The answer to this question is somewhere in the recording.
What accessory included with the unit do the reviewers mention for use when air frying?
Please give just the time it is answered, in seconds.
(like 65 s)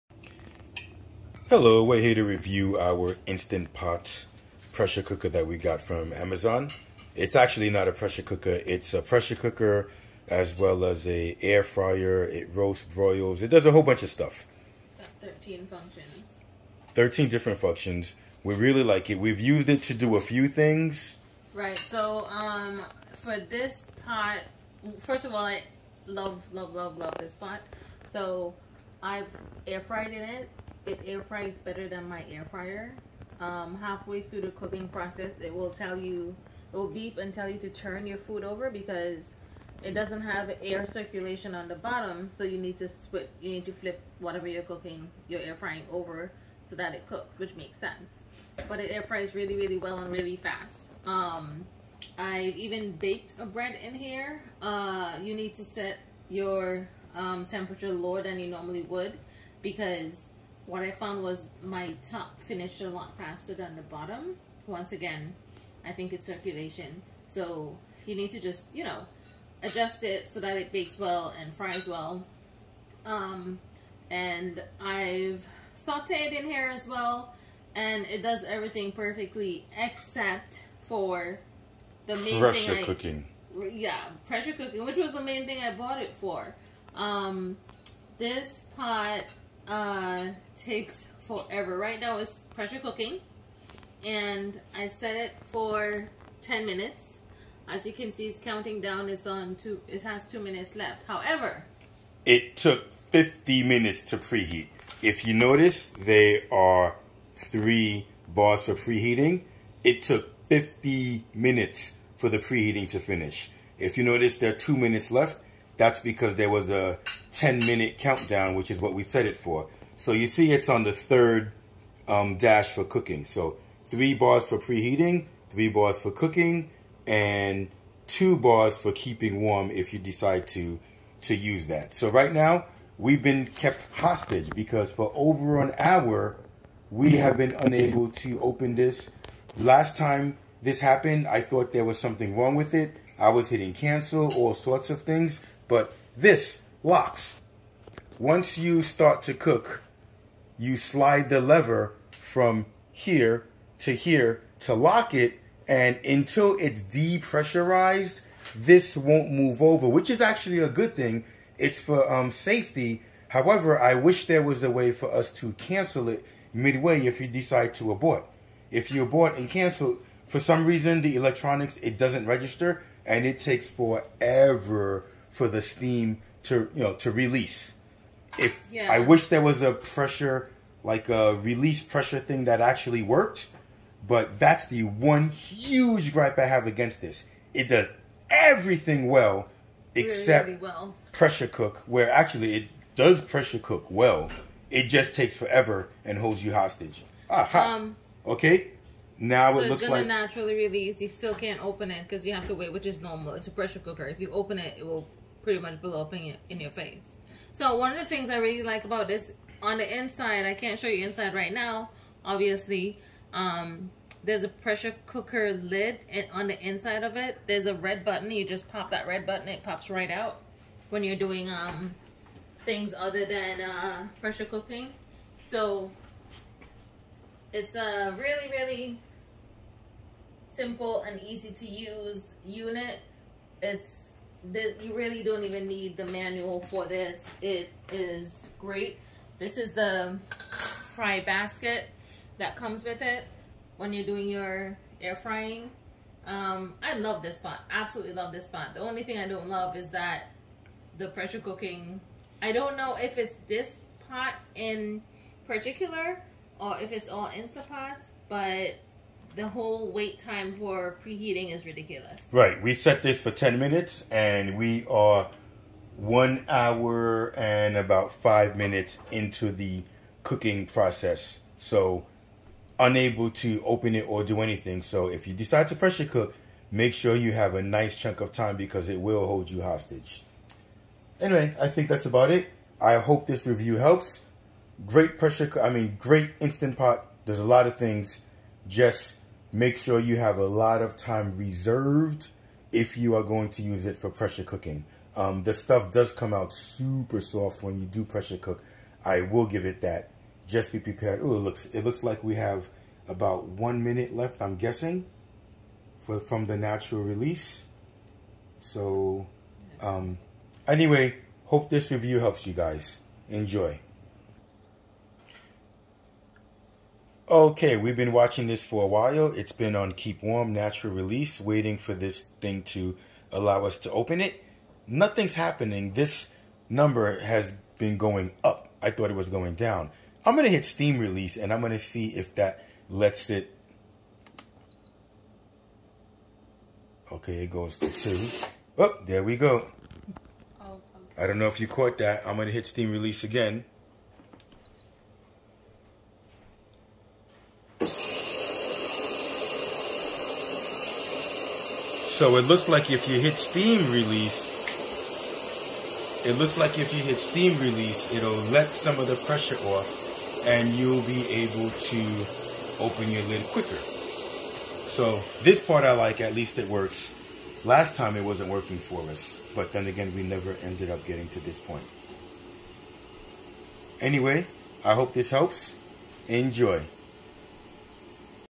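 240 s.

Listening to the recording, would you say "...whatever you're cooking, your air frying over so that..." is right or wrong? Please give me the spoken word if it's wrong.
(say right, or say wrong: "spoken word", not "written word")
right.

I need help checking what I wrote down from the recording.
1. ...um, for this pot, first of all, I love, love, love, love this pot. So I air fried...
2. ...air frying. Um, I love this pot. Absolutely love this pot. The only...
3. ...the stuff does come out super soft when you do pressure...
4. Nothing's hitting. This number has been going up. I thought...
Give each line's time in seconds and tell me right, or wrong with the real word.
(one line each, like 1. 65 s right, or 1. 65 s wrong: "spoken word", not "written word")
1. 22 s right
2. 244 s right
3. 295 s right
4. 324 s wrong: "happening", not "hitting".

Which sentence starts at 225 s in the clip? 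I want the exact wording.
So it's a uh, really, really simple and easy to use unit.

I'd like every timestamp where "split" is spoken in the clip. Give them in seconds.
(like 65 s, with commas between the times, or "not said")
42 s.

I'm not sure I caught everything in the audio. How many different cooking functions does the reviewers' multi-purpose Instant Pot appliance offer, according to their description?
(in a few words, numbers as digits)
13.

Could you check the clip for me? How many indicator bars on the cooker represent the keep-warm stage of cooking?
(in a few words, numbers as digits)
2.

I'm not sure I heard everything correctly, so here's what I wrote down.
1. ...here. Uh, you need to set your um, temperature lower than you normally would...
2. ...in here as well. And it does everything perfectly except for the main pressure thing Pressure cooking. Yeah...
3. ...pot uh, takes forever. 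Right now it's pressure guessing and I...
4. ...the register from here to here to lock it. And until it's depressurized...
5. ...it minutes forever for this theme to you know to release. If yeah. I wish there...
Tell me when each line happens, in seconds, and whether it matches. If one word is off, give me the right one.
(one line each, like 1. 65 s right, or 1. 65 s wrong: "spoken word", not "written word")
1. 53 s right
2. 76 s right
3. 88 s wrong: "cooking", not "guessing"
4. 151 s wrong: "lever", not "register"
5. 173 s wrong: "takes", not "minutes".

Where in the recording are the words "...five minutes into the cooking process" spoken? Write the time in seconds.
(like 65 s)
268 s.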